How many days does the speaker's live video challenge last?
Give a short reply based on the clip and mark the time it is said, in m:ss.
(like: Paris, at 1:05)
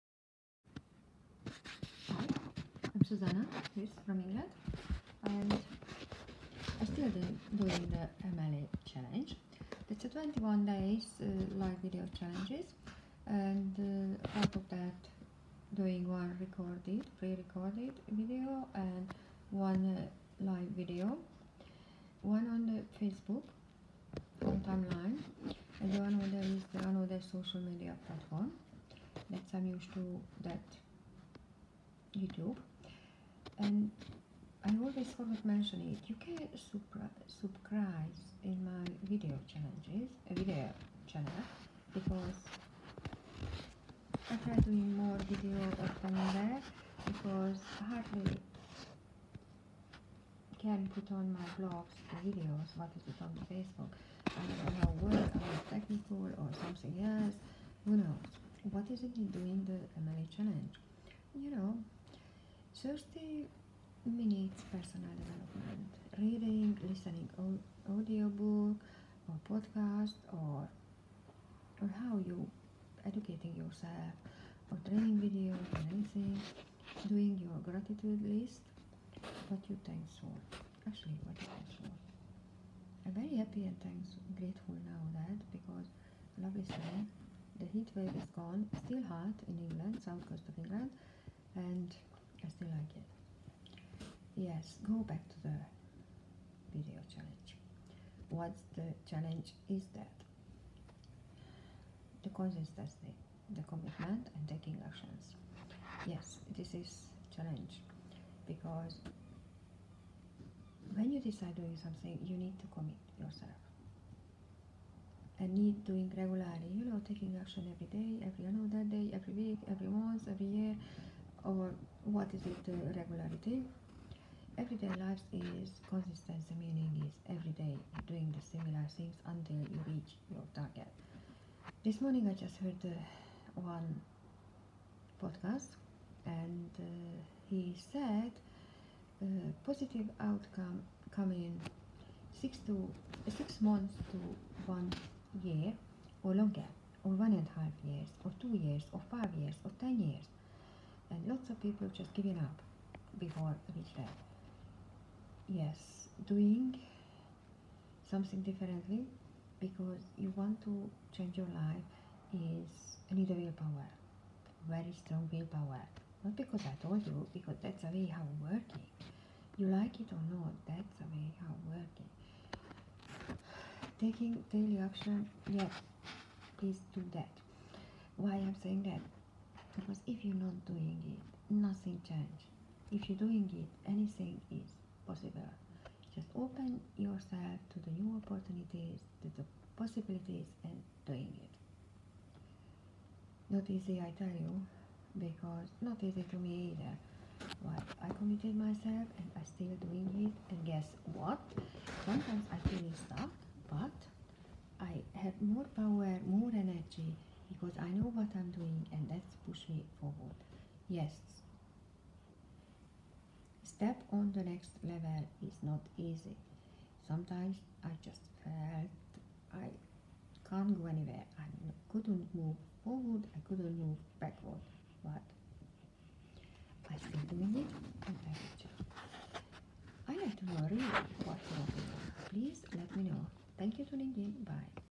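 21 days, at 0:10.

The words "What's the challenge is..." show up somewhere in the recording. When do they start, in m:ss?
1:38.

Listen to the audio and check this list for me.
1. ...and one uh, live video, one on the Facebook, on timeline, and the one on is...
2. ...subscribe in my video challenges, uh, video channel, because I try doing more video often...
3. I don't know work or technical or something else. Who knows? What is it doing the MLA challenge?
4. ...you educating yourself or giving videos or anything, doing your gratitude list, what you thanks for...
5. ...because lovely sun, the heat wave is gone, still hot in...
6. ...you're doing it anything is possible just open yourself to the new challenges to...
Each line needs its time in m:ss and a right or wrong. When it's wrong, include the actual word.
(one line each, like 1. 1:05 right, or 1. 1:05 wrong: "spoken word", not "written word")
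1. 0:18 right
2. 0:36 right
3. 0:54 right
4. 1:12 wrong: "training", not "giving"
5. 1:25 right
6. 3:03 wrong: "opportunities", not "challenges".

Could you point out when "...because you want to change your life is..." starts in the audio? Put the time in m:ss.
2:39.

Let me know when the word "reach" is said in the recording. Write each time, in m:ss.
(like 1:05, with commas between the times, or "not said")
2:09, 2:33.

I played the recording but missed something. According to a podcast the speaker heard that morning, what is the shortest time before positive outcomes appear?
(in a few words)
6 months.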